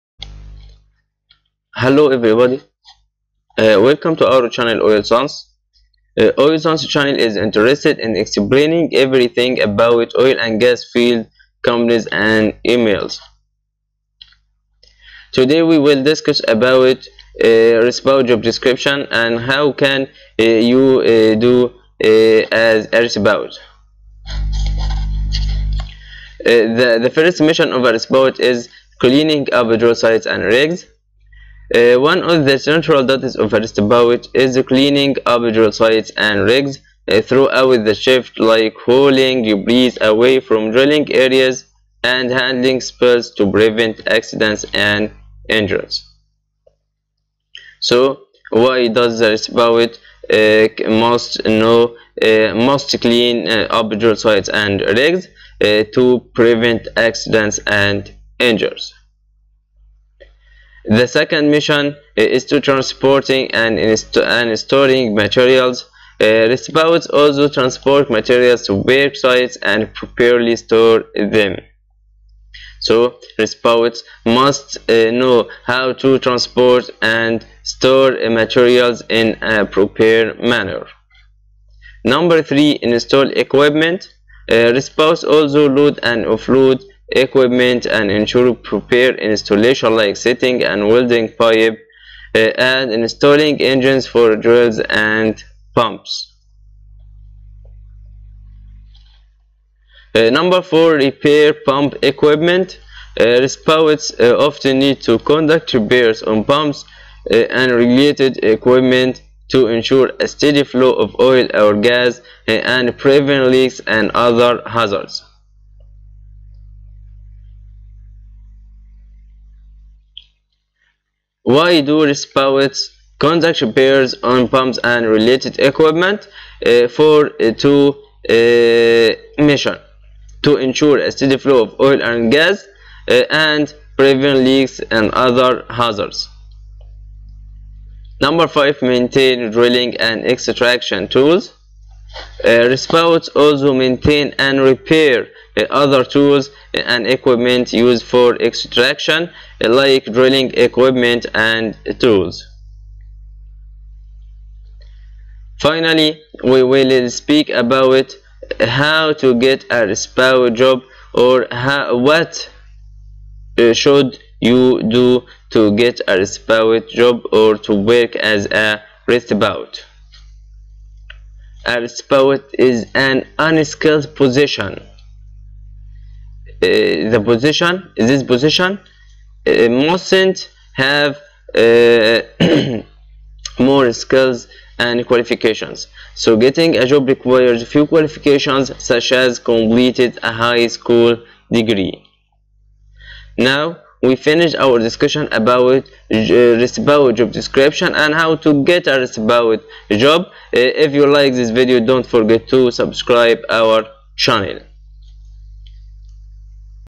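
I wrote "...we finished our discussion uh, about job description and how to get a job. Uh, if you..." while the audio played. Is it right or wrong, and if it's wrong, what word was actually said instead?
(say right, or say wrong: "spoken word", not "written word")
right.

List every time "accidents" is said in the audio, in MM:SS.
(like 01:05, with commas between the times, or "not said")
00:44, 00:56.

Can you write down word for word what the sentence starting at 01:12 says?
So roustabouts must uh, know how to transport and store uh, materials in a proper manner.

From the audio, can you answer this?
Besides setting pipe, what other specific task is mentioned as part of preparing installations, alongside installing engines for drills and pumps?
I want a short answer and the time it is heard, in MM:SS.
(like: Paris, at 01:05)
welding pipe, at 01:30.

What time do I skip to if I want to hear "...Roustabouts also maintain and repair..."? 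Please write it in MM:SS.
02:22.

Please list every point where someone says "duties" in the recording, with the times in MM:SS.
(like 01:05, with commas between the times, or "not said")
00:33.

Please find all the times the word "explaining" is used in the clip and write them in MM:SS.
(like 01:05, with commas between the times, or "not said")
00:08.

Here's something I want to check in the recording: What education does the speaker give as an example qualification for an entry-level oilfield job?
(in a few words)
high school degree.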